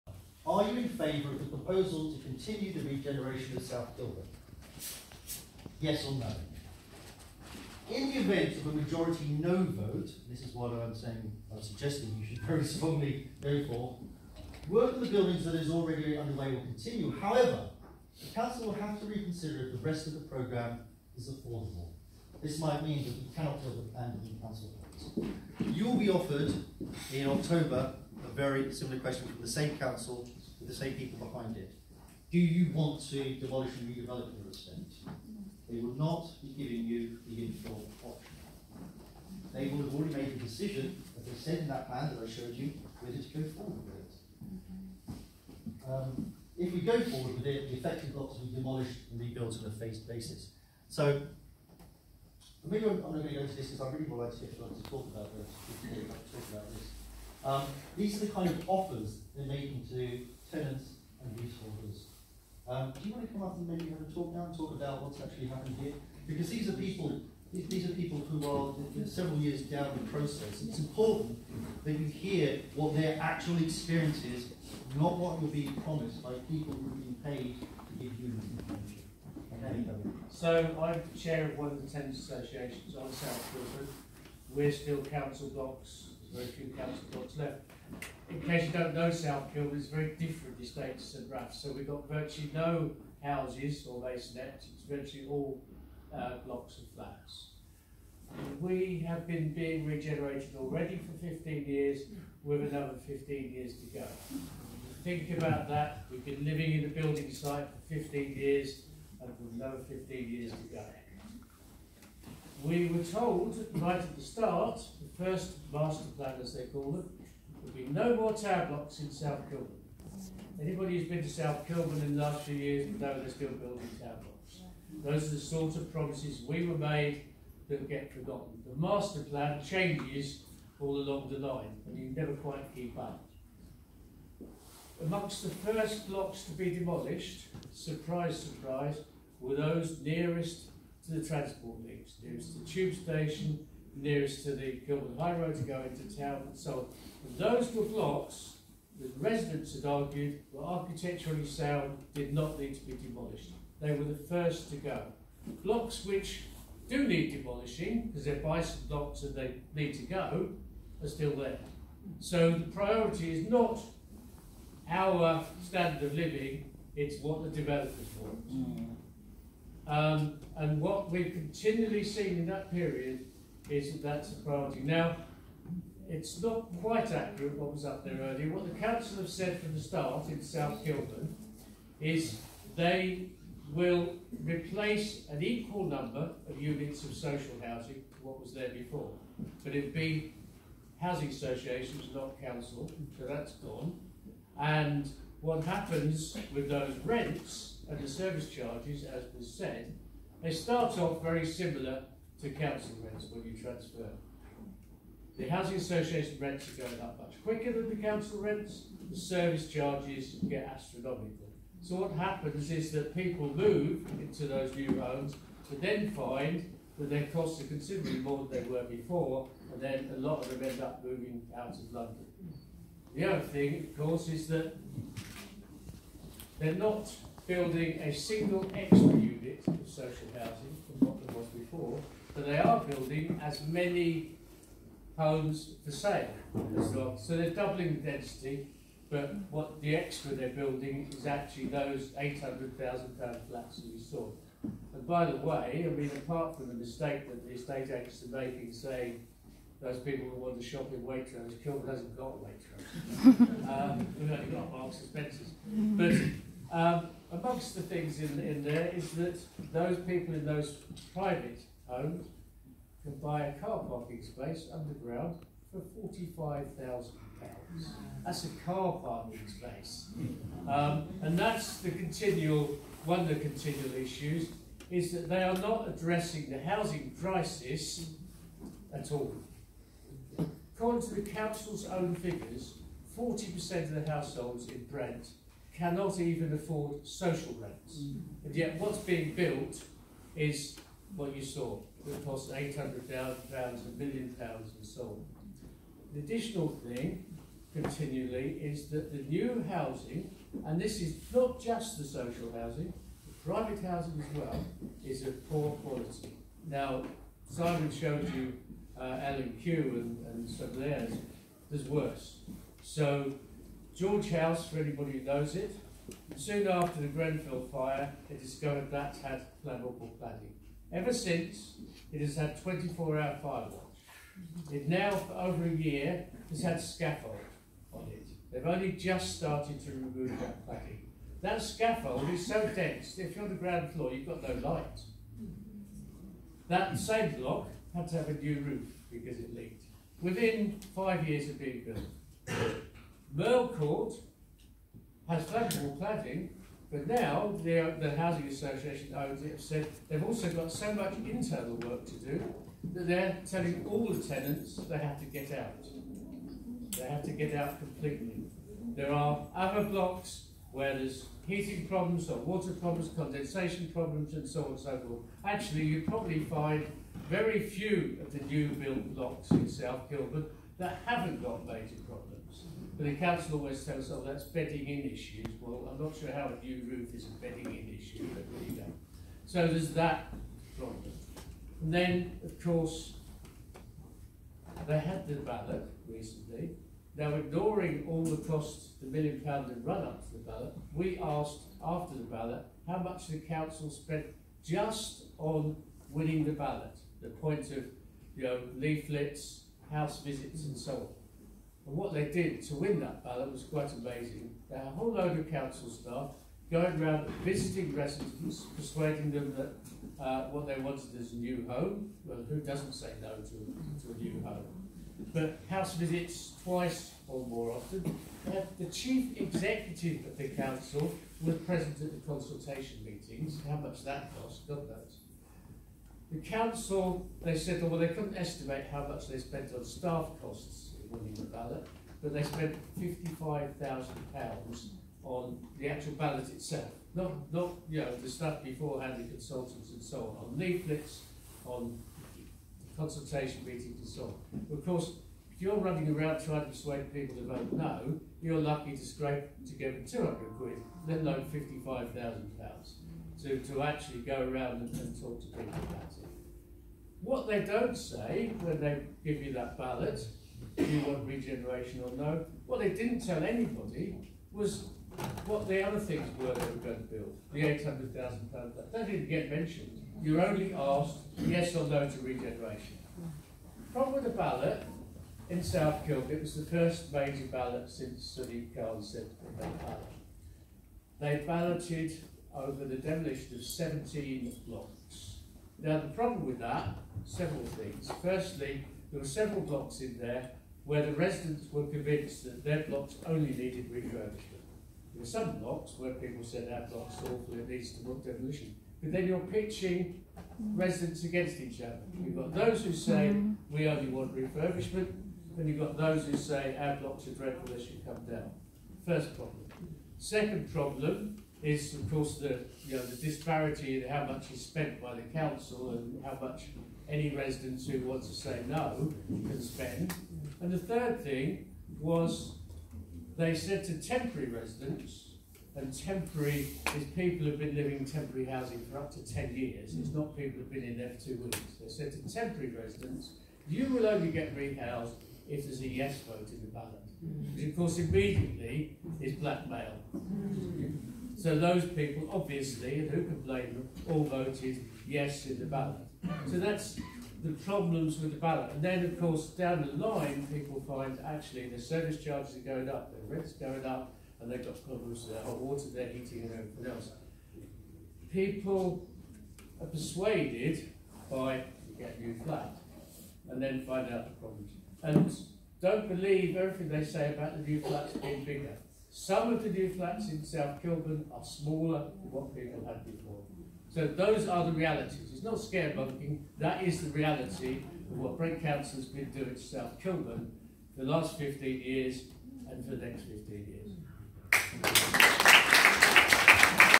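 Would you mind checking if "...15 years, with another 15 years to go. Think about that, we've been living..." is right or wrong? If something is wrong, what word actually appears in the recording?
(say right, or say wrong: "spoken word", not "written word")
right.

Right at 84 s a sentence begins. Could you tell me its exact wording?
We're still council blocks, very few council blocks left in case you don't know South Kilburn, it's very different estates St Raphael's.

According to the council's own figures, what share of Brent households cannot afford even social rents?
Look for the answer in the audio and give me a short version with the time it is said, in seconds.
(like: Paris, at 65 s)
40%, at 283 s.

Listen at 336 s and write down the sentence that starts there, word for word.
That same block had to have a new roof because it leaked.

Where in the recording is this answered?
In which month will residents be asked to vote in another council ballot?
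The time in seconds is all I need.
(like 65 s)
27 s.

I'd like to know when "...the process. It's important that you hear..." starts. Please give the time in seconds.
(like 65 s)
70 s.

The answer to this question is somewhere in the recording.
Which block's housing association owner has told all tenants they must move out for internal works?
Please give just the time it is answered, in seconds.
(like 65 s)
343 s.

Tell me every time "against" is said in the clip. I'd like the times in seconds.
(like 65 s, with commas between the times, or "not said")
501 s.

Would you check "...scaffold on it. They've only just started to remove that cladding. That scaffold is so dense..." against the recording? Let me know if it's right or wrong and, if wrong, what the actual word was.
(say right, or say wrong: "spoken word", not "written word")
right.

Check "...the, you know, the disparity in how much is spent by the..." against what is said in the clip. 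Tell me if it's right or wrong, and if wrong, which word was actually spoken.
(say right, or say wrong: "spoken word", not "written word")
right.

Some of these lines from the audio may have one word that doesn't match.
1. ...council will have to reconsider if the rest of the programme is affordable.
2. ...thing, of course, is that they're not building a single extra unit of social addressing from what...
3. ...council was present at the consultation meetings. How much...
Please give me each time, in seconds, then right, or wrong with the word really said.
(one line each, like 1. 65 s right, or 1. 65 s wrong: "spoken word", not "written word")
1. 18 s right
2. 223 s wrong: "housing", not "addressing"
3. 420 s right.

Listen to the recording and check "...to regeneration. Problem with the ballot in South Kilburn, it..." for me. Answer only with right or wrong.
right.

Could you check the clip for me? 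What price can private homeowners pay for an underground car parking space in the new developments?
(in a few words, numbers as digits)
£45,000.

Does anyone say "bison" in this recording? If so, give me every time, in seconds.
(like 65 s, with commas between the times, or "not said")
158 s.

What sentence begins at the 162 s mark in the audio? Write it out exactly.
So the priority is not our standard of living, it's what the developers want.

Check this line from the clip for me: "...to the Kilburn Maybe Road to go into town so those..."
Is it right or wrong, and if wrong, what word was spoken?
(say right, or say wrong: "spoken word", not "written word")
wrong: "High", not "Maybe".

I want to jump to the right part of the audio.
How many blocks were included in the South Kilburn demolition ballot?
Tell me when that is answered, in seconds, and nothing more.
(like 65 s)
483 s.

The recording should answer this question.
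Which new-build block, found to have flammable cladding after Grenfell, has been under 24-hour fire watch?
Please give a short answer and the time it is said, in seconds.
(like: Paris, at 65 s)
George House, at 313 s.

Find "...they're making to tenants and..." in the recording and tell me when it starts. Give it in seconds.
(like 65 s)
59 s.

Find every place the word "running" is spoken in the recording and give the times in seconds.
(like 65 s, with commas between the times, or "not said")
445 s.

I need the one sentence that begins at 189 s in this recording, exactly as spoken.
But it would be housing associations, not council, so that's gone.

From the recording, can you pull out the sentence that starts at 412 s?
Well, who doesn't say no to, to a new home?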